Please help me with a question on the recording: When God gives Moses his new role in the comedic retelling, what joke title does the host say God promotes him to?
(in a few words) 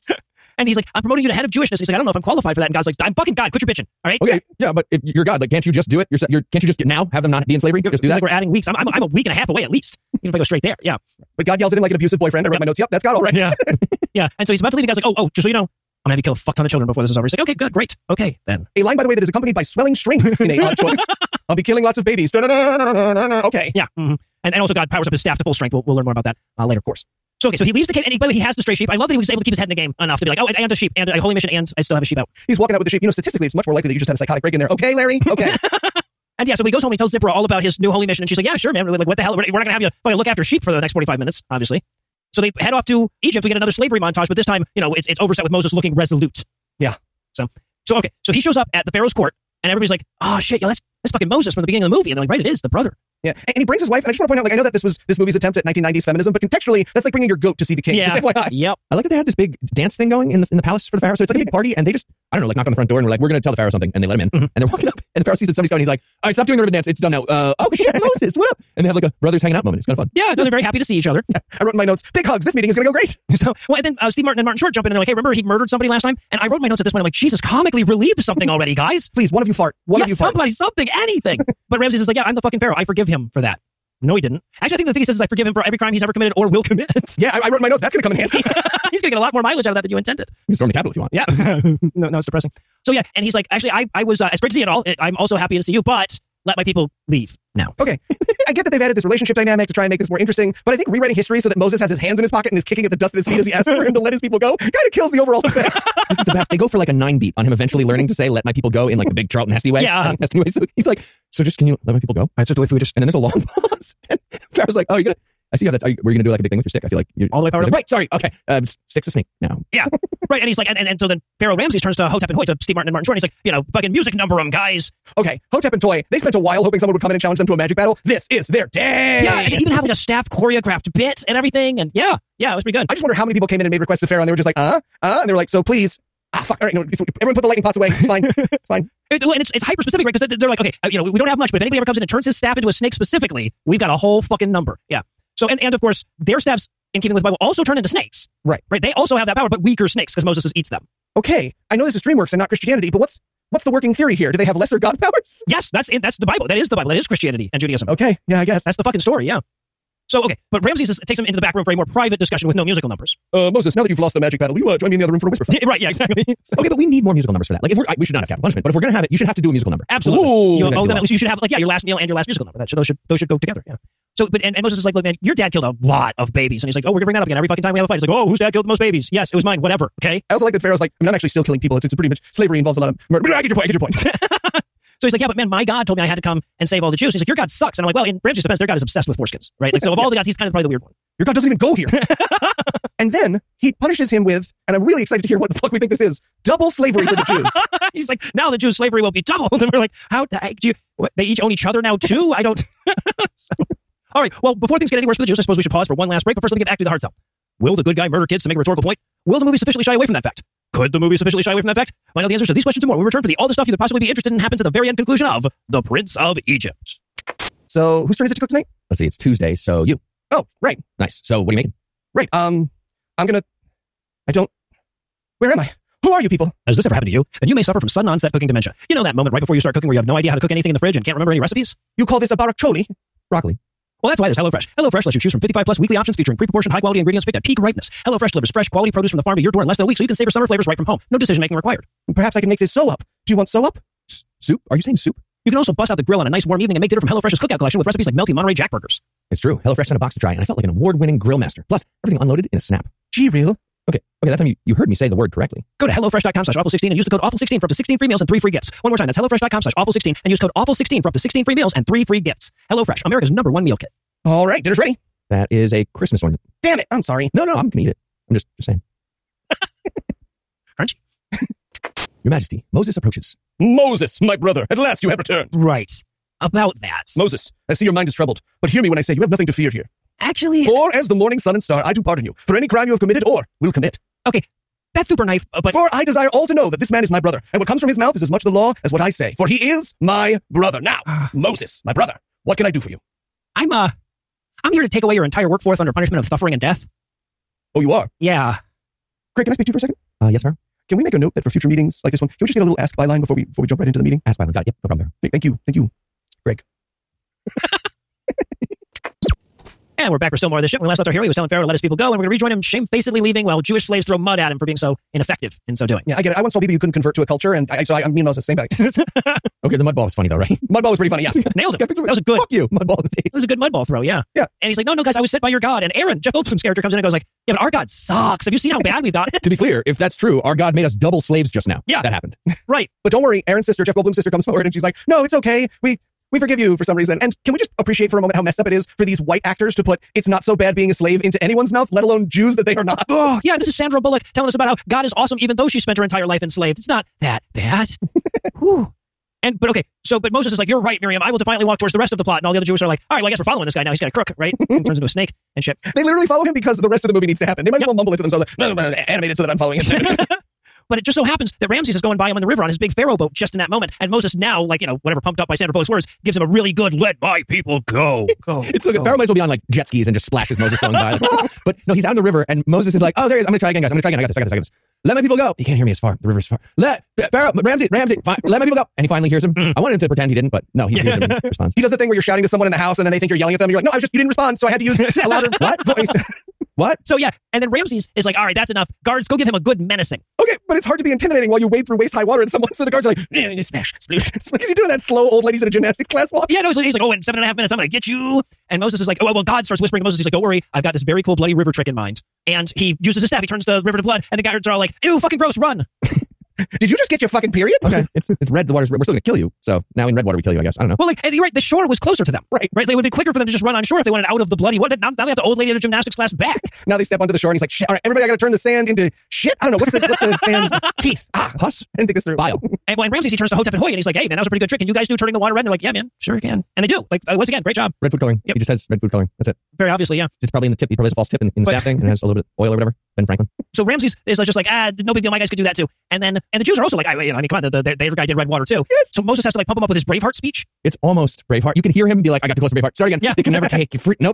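Head of Jewishness.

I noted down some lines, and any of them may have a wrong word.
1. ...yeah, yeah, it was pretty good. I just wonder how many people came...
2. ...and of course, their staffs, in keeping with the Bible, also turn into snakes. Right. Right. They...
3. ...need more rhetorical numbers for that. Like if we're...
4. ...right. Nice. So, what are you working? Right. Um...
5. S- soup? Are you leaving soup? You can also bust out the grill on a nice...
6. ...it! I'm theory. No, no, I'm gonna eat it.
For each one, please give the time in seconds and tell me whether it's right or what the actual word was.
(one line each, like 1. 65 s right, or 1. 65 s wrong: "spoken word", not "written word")
1. 131 s right
2. 145 s right
3. 166 s wrong: "musical", not "rhetorical"
4. 220 s wrong: "making", not "working"
5. 244 s wrong: "saying", not "leaving"
6. 266 s wrong: "sorry", not "theory".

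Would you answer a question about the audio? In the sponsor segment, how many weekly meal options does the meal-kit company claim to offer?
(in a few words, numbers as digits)
55 plus.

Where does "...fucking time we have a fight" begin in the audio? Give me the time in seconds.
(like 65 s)
177 s.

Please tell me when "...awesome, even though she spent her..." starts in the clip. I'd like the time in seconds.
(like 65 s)
345 s.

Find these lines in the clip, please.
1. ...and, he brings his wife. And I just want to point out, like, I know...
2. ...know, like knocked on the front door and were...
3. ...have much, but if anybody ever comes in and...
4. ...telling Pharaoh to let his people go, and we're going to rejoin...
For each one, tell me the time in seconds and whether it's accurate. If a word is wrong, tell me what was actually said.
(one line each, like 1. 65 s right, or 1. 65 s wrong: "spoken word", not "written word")
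1. 53 s right
2. 62 s right
3. 141 s right
4. 311 s right.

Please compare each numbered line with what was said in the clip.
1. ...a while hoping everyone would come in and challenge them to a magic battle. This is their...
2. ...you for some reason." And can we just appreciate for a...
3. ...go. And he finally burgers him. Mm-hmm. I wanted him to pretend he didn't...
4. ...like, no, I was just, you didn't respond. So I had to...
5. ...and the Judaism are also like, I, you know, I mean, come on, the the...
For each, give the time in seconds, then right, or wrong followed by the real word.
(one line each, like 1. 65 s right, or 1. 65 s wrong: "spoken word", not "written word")
1. 126 s wrong: "someone", not "everyone"
2. 336 s right
3. 378 s wrong: "hears", not "burgers"
4. 383 s right
5. 436 s wrong: "Jews", not "Judaism".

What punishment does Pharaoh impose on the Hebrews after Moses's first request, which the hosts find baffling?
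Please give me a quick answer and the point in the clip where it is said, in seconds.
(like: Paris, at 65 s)
Double slavery, at 196 s.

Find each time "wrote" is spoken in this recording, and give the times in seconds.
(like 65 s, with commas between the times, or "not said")
12 s, 71 s, 76 s, 87 s.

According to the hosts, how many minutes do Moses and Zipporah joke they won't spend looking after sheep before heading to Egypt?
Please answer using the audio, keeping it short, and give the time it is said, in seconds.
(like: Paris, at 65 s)
45, at 40 s.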